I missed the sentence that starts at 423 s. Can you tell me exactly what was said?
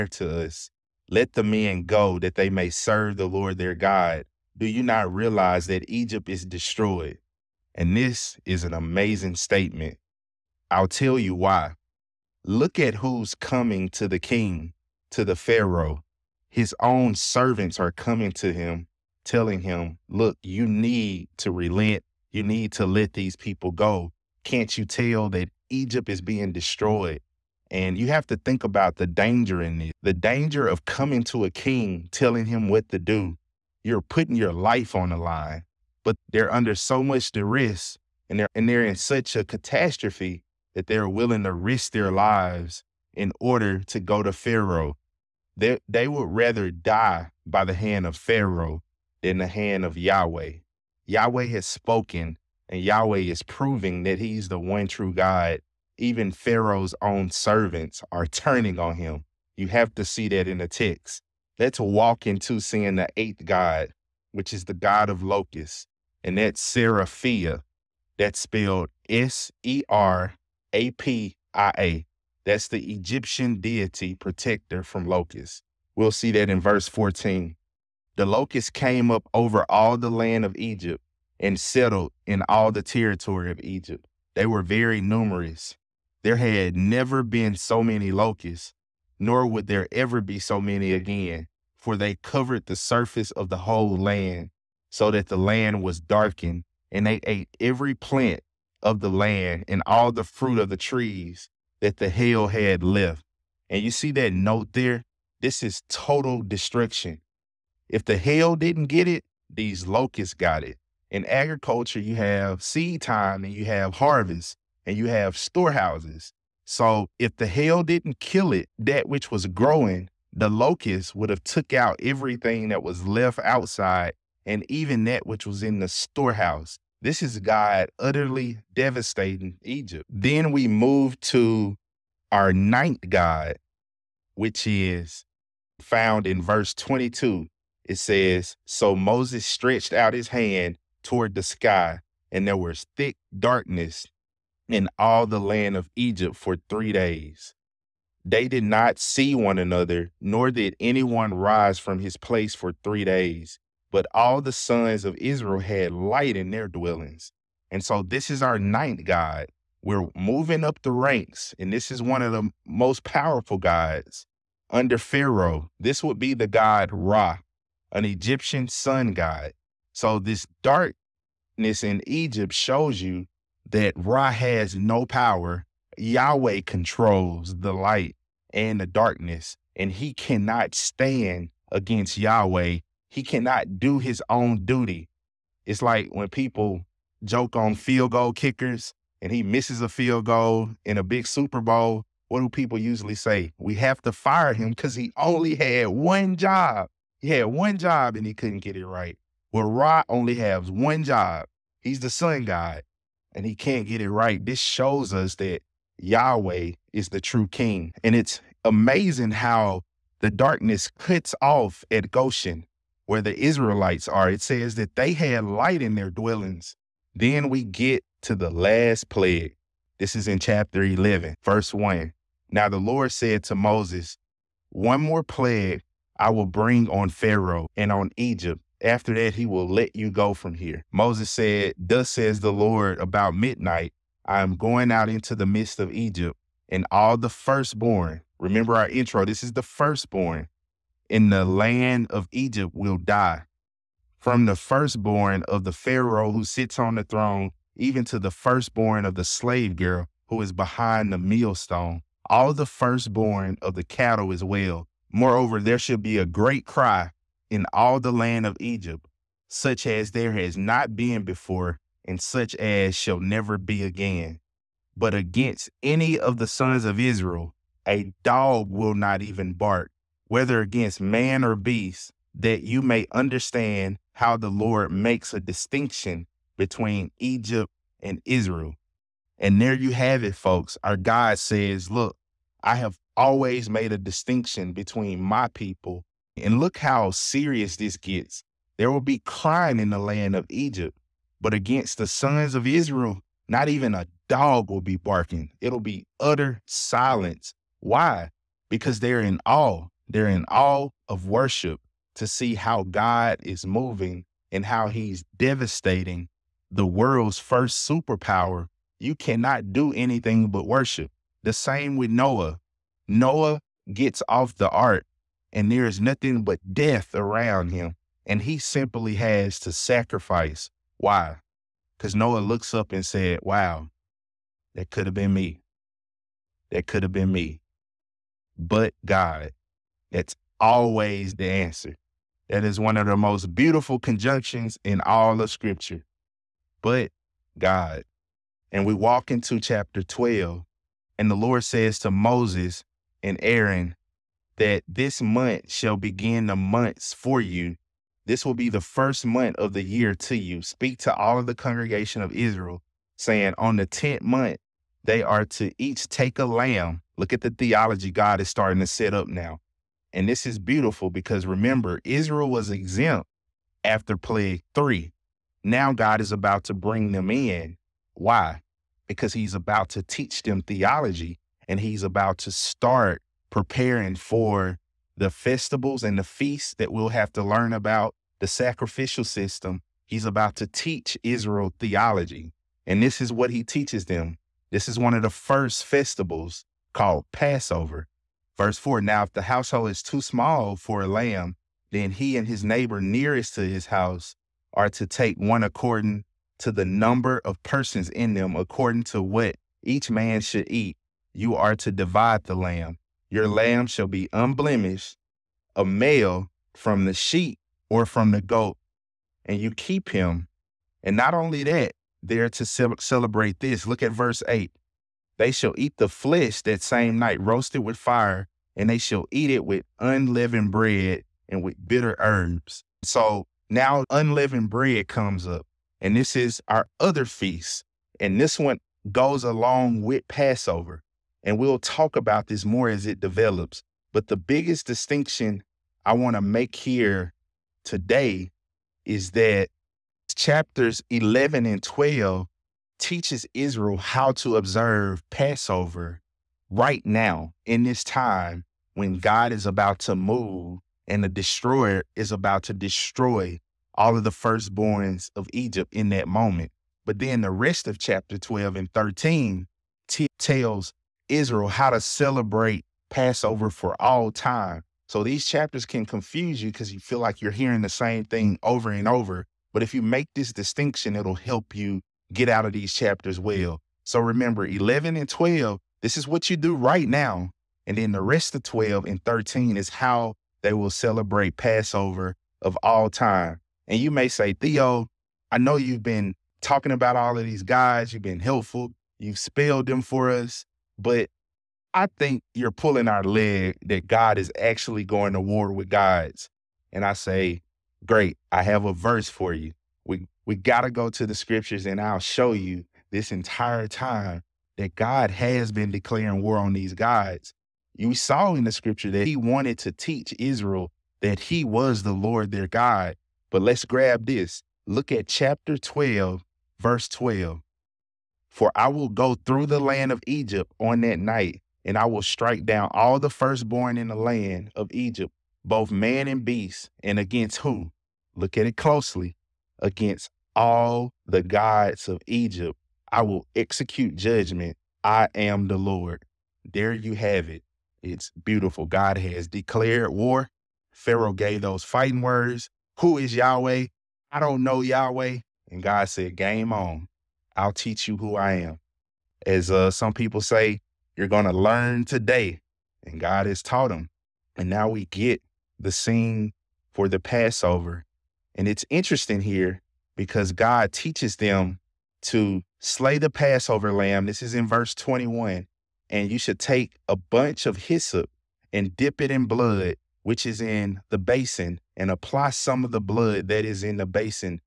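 So now unleavened bread comes up, and this is our other feast.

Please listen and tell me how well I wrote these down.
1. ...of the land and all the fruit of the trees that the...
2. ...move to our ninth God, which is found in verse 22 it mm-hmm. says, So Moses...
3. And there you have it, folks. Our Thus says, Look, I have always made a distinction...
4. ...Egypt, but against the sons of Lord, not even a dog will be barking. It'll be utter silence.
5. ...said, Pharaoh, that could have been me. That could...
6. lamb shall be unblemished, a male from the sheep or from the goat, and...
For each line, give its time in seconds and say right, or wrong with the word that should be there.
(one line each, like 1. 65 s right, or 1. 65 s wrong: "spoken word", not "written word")
1. 98 s right
2. 130 s right
3. 279 s wrong: "God", not "Thus"
4. 290 s wrong: "Israel", not "Lord"
5. 323 s wrong: "Wow", not "Pharaoh"
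6. 403 s right.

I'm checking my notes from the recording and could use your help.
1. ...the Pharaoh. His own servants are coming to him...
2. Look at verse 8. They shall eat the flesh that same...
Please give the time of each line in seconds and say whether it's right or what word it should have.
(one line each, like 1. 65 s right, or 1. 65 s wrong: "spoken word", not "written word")
1. 15 s right
2. 413 s right.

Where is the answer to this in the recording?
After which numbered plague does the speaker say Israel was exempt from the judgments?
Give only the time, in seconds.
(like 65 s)
364 s.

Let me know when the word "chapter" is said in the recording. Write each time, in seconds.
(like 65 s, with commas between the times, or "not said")
220 s, 339 s, 440 s, 457 s, 465 s, 472 s, 515 s.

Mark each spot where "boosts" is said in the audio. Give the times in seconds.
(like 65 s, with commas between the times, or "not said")
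not said.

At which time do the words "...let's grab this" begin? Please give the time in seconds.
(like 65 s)
513 s.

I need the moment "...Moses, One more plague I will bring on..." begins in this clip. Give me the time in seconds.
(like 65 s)
223 s.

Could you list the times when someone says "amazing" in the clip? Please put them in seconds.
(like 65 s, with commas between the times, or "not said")
8 s, 208 s.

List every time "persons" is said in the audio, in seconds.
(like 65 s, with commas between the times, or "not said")
397 s.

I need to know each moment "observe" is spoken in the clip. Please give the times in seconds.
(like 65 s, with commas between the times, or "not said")
444 s.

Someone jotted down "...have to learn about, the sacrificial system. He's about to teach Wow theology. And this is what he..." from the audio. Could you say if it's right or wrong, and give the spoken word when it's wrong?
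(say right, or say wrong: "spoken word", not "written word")
wrong: "Israel", not "Wow".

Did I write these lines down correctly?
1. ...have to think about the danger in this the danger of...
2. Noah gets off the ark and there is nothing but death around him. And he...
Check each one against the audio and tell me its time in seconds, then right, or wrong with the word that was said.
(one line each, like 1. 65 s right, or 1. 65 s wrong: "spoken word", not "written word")
1. 28 s right
2. 313 s right.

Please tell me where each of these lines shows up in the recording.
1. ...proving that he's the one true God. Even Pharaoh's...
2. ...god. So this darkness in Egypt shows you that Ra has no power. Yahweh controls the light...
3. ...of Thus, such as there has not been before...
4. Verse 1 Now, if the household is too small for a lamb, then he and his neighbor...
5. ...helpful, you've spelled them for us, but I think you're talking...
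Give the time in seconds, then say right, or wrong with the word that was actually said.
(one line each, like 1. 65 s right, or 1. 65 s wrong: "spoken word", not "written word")
1. 53 s right
2. 169 s right
3. 258 s wrong: "Egypt", not "Thus"
4. 388 s wrong: "4", not "1"
5. 488 s wrong: "pulling", not "talking".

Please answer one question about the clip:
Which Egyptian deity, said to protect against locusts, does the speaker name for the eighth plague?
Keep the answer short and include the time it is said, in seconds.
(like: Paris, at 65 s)
Serapia, at 66 s.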